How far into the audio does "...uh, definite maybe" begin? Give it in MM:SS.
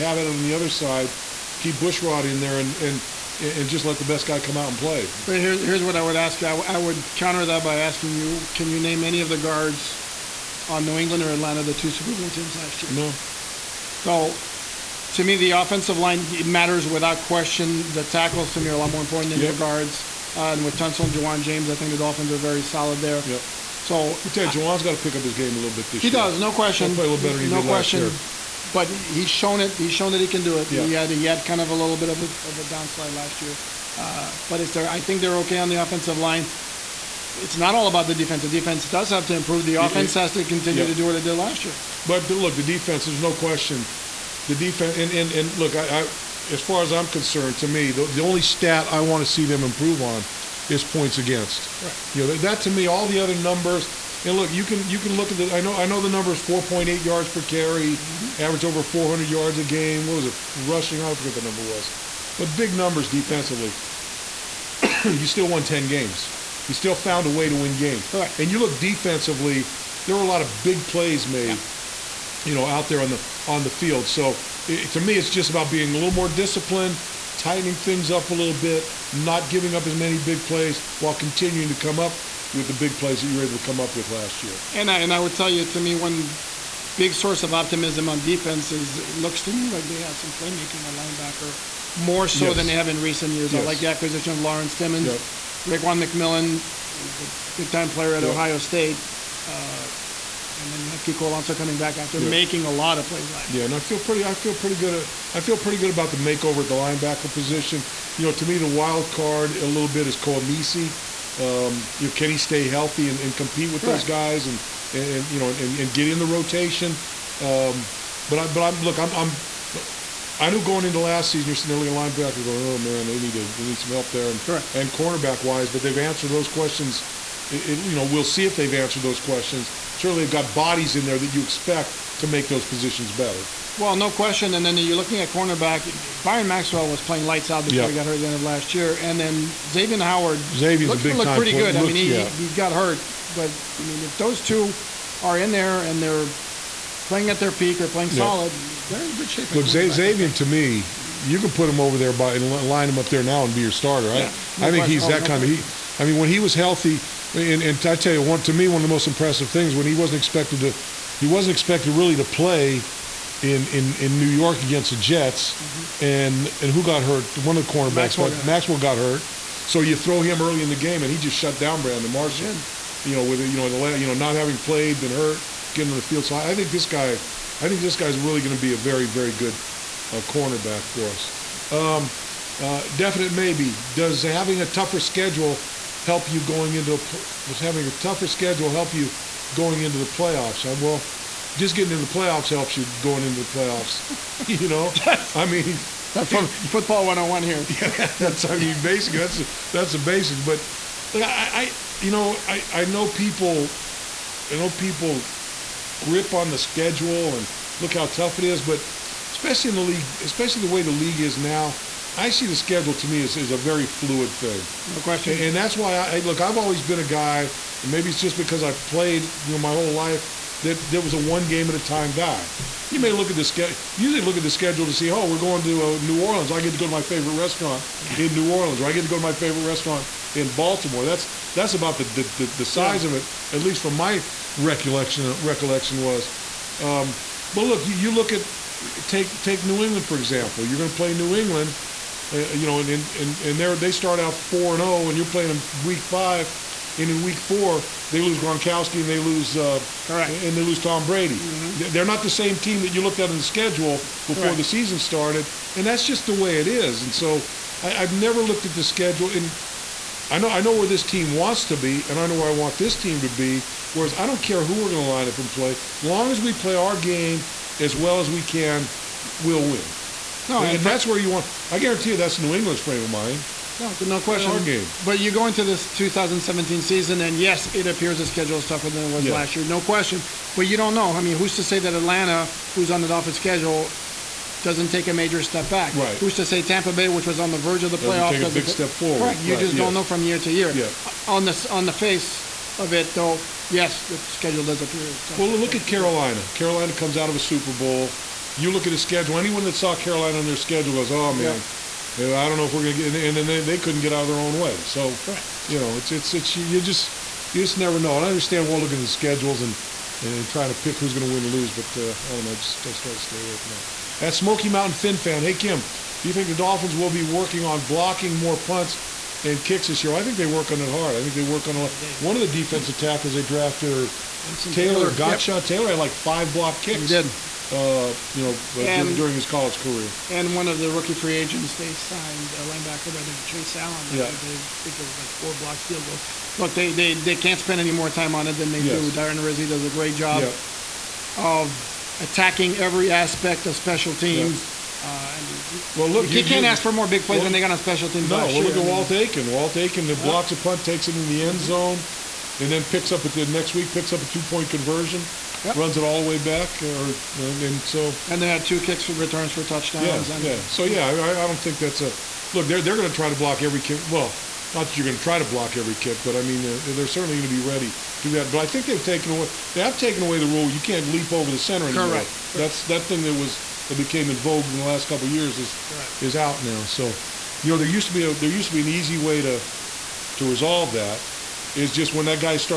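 03:02.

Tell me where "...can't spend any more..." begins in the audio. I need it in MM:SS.
05:37.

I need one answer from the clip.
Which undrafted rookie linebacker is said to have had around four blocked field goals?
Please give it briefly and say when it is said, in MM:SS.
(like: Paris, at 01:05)
Chase Allen, at 05:33.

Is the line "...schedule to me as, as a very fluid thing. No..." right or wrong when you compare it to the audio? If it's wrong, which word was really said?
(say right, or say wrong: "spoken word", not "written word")
right.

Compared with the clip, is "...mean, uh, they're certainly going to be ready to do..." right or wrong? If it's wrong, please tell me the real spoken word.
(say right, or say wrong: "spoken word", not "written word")
right.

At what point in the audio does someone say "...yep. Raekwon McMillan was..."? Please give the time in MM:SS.
01:35.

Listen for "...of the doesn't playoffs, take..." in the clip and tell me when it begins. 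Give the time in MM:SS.
04:47.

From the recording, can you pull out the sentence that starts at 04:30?
No, and, and that's where you want.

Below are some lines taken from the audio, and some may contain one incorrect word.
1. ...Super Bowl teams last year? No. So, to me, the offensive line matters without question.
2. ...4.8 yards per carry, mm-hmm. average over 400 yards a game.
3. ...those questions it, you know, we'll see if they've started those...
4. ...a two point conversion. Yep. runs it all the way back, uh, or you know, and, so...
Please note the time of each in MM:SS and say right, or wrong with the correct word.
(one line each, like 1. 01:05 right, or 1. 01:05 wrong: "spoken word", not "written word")
1. 00:11 right
2. 00:56 right
3. 02:06 wrong: "answered", not "started"
4. 05:54 right.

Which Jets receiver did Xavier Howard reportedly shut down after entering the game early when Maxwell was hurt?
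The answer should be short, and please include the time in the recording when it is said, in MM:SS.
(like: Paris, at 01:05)
Brandon Marshall, at 02:51.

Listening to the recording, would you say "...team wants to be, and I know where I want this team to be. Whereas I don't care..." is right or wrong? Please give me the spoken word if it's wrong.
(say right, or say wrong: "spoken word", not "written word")
right.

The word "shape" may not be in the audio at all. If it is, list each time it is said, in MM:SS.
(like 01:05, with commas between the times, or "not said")
02:29.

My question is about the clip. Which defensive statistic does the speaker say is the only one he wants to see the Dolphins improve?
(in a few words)
Points against.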